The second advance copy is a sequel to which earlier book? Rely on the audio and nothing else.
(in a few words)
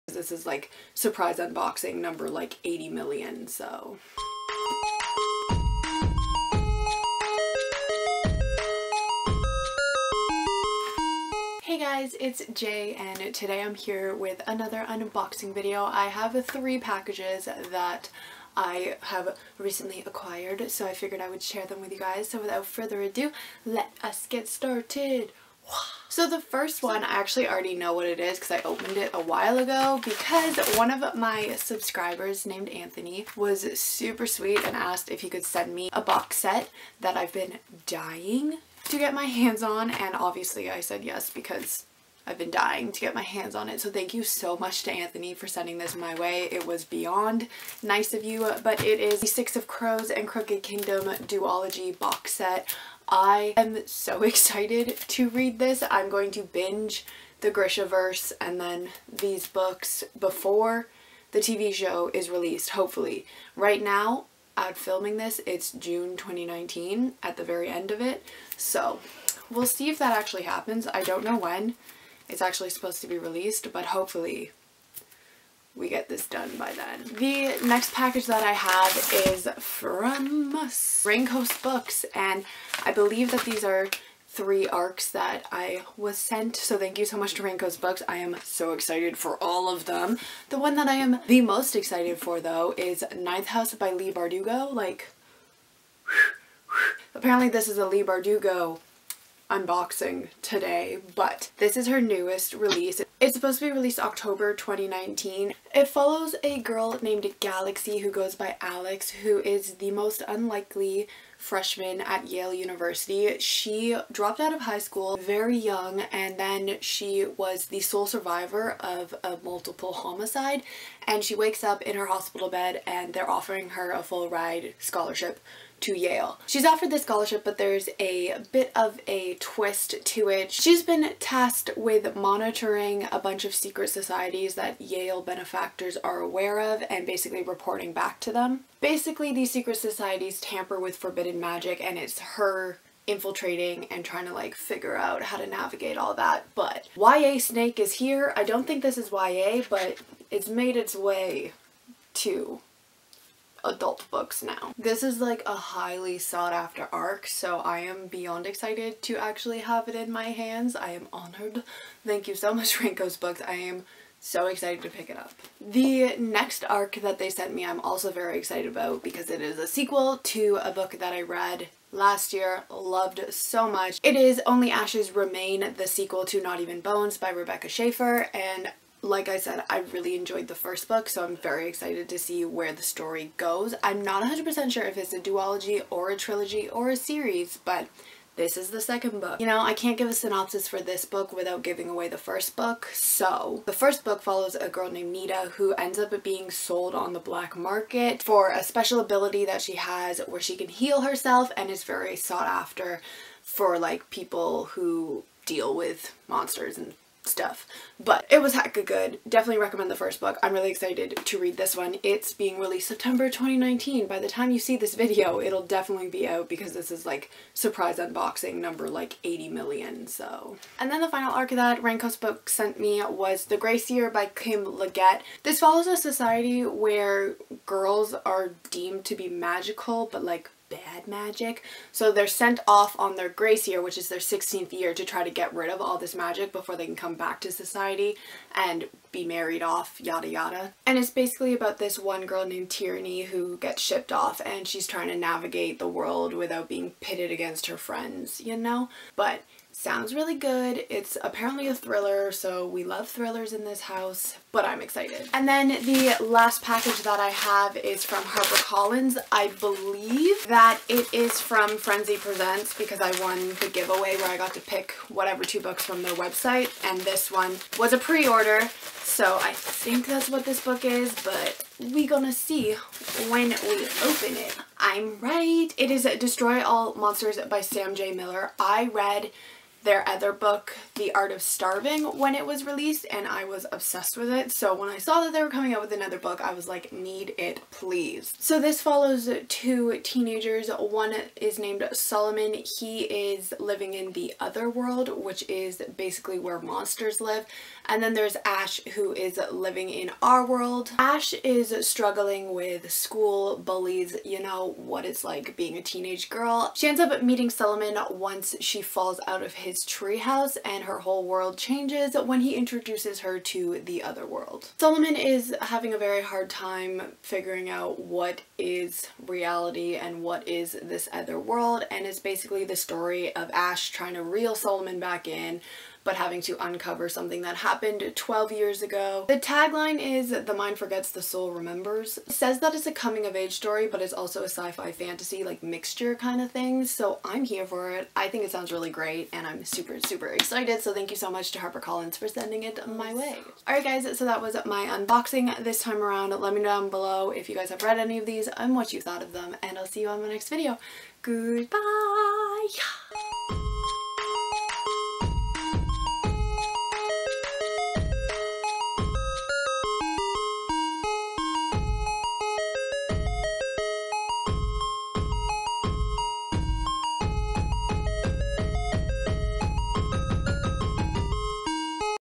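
Not Even Bones.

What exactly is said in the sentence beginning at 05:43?
Alright guys, so that was my unboxing this time around.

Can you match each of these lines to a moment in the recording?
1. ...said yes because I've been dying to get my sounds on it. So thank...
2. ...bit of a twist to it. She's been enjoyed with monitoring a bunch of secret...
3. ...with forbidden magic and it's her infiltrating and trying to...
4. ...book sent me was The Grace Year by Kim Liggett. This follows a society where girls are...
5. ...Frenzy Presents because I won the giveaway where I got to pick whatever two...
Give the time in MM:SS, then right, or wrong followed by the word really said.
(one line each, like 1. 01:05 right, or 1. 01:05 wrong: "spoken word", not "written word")
1. 00:40 wrong: "hands", not "sounds"
2. 02:08 wrong: "tasked", not "enjoyed"
3. 02:20 right
4. 03:42 right
5. 04:21 right.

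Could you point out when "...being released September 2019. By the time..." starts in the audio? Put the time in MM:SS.
03:32.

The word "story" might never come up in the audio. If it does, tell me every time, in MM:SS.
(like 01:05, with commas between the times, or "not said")
03:02, 05:22, 05:33.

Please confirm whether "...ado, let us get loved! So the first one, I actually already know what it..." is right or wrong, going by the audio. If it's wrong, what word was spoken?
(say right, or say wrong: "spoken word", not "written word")
wrong: "started", not "loved".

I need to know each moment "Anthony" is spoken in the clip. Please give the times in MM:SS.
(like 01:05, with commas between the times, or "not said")
00:32, 00:44.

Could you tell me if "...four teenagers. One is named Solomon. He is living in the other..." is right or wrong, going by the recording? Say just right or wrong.
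wrong.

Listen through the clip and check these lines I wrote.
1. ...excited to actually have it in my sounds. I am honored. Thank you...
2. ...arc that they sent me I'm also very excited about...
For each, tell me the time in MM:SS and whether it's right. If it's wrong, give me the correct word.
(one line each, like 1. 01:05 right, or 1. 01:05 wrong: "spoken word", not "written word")
1. 02:38 wrong: "hands", not "sounds"
2. 02:46 right.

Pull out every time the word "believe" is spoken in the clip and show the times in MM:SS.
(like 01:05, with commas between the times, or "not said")
01:22, 04:19.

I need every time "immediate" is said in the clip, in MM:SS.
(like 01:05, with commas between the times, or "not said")
not said.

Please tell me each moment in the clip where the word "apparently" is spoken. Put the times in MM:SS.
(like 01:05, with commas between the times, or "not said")
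01:37, 04:11.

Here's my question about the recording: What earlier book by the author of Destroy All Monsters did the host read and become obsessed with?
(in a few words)
The Art of Starving.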